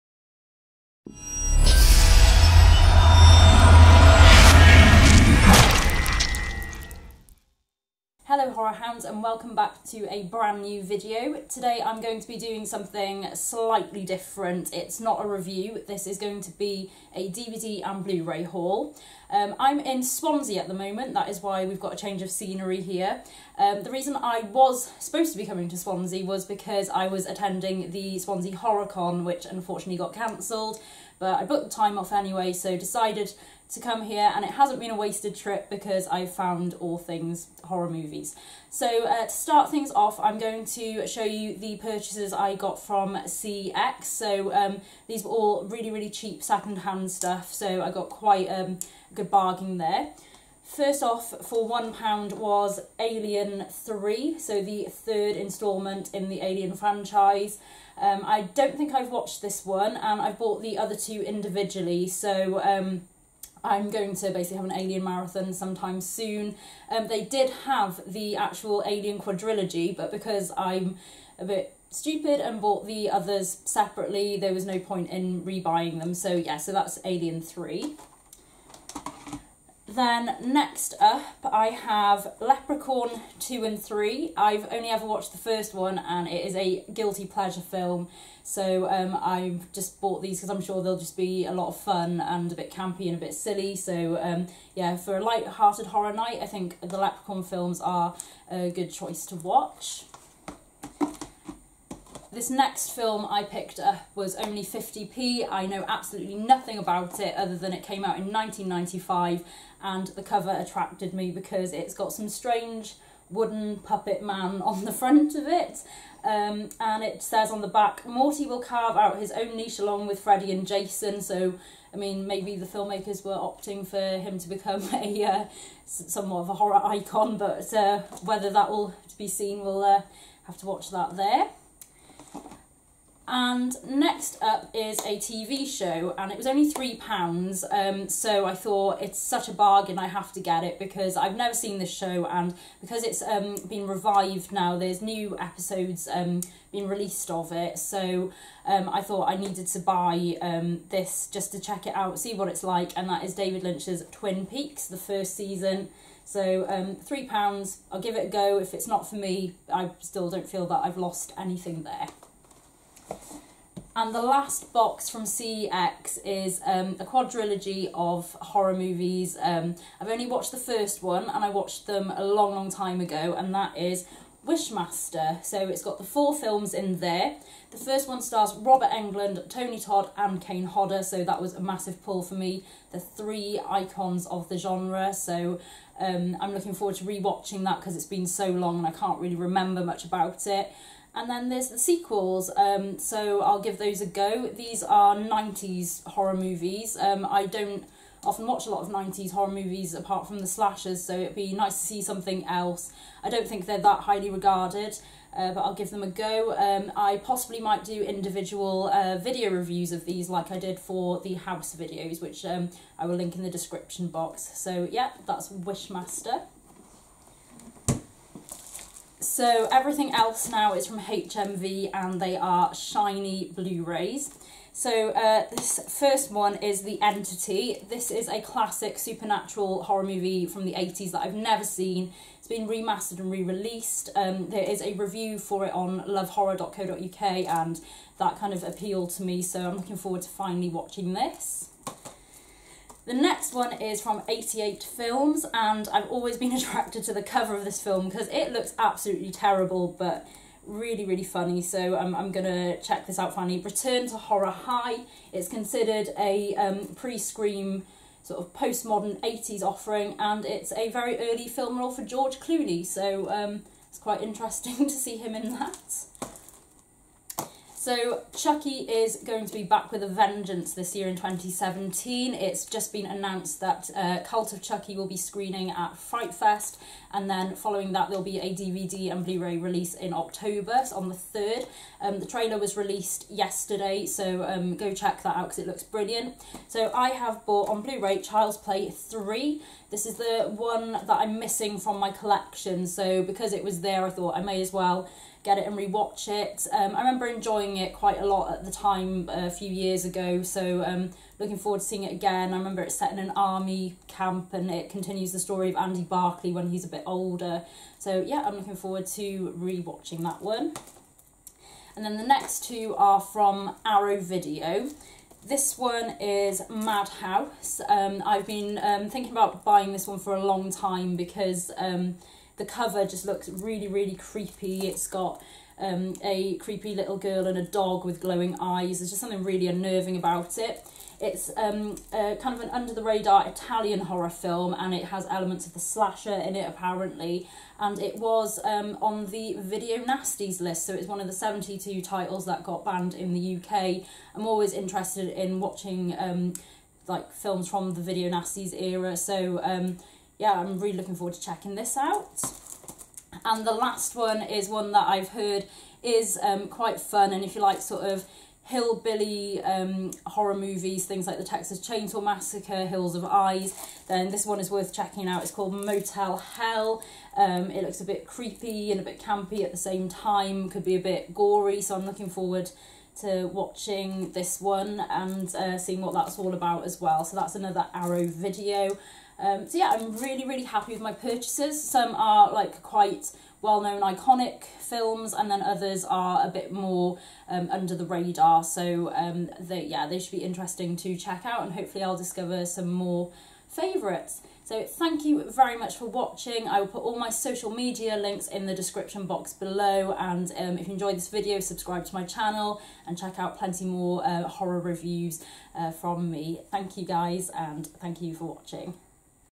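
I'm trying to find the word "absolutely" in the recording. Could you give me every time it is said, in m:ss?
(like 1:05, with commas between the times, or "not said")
1:45, 4:08.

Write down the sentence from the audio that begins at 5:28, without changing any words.
There's just something really unnerving about it.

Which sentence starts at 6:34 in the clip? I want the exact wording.
So thank you very much for watching.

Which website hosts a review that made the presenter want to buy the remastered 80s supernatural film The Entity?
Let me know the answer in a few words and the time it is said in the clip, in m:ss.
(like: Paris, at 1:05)
lovehorror.co.uk, at 3:56.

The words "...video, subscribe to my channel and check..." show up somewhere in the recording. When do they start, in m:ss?
6:41.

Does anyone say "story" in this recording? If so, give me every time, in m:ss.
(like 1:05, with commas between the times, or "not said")
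5:05.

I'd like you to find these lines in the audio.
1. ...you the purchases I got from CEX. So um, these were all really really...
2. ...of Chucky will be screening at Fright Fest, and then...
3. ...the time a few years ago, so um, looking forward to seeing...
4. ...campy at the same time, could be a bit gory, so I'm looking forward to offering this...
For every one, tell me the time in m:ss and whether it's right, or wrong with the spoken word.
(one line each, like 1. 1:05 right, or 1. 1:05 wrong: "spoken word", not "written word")
1. 0:41 right
2. 4:34 right
3. 4:58 right
4. 6:09 wrong: "watching", not "offering".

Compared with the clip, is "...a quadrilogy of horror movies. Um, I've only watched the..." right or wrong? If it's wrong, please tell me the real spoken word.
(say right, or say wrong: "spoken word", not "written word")
right.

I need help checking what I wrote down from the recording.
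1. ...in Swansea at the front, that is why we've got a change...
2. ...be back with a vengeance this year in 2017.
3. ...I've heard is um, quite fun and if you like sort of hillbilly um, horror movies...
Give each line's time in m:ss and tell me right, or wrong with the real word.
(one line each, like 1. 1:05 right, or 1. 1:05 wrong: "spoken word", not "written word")
1. 0:19 wrong: "moment", not "front"
2. 4:29 right
3. 5:55 right.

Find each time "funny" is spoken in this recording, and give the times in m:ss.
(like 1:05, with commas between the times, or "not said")
4:11.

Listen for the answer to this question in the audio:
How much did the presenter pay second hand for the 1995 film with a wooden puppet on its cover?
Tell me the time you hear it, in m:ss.
1:44.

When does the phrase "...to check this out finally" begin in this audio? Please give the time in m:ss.
4:12.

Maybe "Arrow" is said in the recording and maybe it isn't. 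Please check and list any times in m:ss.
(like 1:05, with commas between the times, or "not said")
5:13, 6:17.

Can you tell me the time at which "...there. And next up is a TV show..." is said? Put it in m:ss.
2:11.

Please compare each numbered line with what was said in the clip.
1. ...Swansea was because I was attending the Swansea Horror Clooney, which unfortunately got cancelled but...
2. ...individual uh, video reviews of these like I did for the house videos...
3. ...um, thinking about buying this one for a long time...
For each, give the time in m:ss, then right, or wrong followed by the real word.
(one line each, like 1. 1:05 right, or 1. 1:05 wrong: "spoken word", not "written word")
1. 0:25 wrong: "Con", not "Clooney"
2. 3:28 right
3. 5:18 right.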